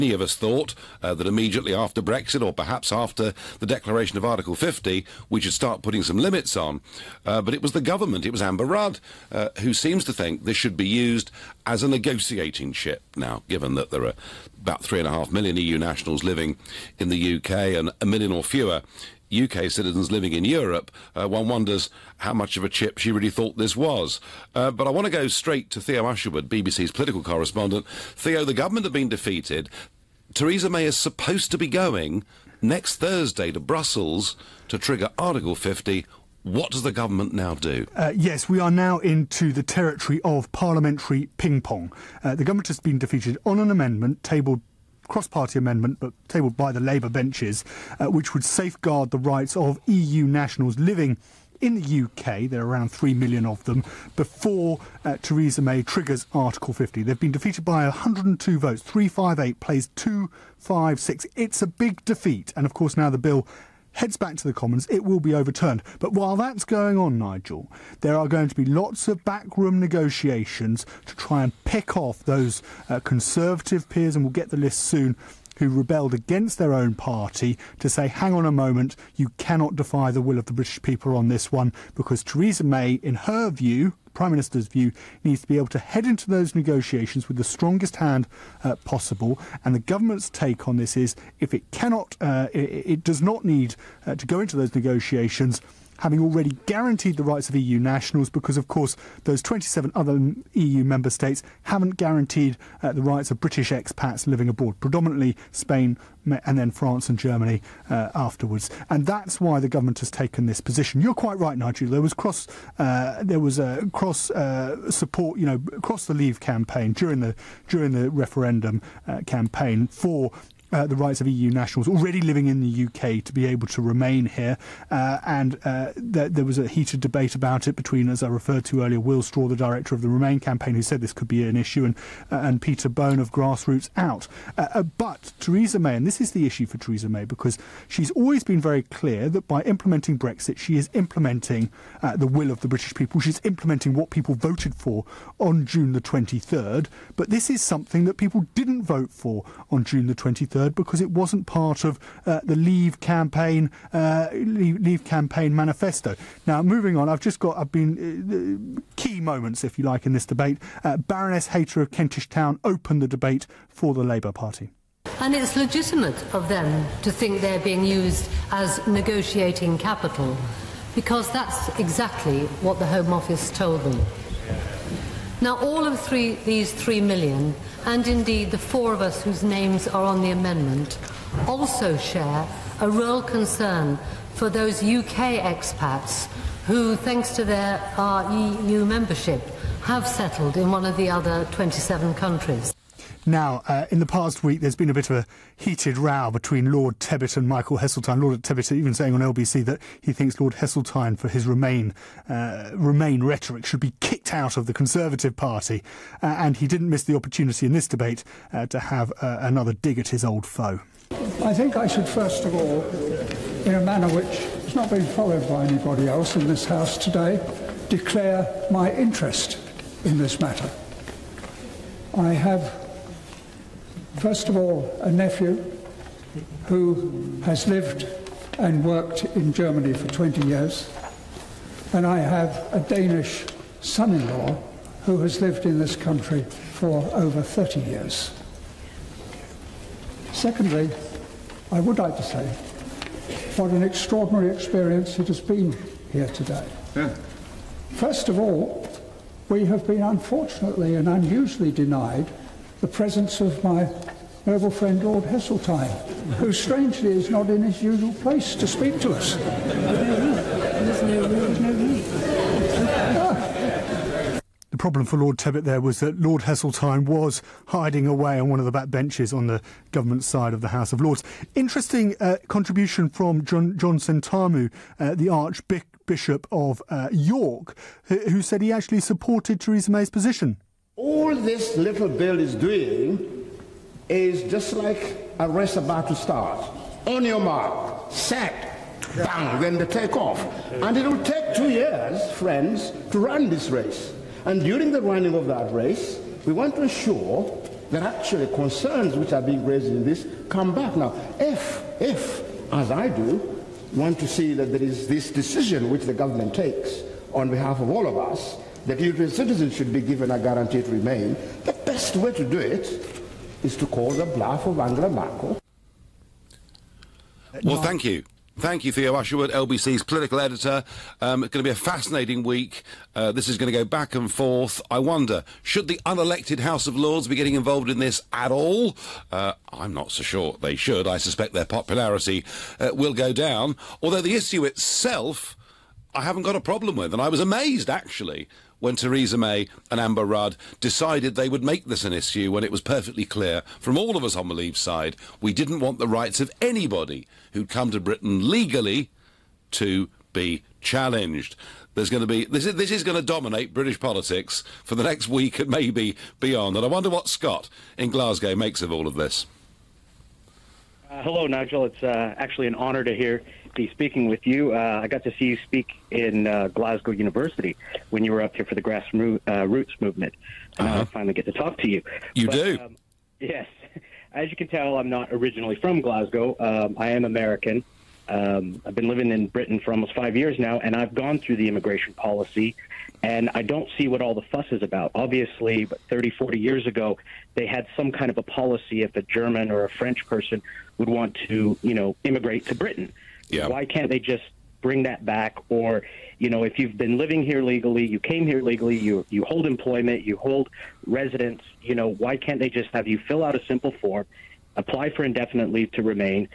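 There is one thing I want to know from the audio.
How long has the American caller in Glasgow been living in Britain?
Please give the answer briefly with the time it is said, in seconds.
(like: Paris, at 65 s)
almost 5 years, at 379 s.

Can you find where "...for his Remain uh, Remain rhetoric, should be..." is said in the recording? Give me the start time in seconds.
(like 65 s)
201 s.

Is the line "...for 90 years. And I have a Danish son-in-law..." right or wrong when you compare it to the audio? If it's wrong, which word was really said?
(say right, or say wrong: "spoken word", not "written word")
wrong: "20", not "90".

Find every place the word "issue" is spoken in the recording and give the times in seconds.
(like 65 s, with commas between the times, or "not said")
131 s, 136 s, 334 s, 342 s.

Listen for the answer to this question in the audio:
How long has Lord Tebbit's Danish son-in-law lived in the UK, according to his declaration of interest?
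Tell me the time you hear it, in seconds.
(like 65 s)
237 s.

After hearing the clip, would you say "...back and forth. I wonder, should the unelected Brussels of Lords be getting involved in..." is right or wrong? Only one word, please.
wrong.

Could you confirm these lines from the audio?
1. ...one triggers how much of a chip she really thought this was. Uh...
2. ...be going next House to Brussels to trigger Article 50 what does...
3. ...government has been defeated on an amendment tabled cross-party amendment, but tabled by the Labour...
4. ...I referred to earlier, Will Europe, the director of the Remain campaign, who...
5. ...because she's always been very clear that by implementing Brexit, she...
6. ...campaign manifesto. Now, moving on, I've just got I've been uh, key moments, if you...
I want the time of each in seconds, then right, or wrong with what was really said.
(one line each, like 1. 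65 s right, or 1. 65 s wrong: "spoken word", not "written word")
1. 21 s wrong: "wonders", not "triggers"
2. 31 s wrong: "Thursday", not "House"
3. 42 s right
4. 128 s wrong: "Straw", not "Europe"
5. 137 s right
6. 155 s right.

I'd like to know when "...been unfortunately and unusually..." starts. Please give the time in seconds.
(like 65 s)
249 s.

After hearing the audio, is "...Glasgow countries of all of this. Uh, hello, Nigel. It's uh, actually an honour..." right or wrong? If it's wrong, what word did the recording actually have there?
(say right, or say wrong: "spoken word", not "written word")
wrong: "makes", not "countries".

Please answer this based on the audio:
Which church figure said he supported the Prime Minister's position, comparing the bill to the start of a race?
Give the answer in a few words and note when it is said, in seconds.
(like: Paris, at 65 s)
John Sentamu, at 273 s.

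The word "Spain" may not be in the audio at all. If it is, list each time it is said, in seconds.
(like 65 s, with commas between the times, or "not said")
105 s.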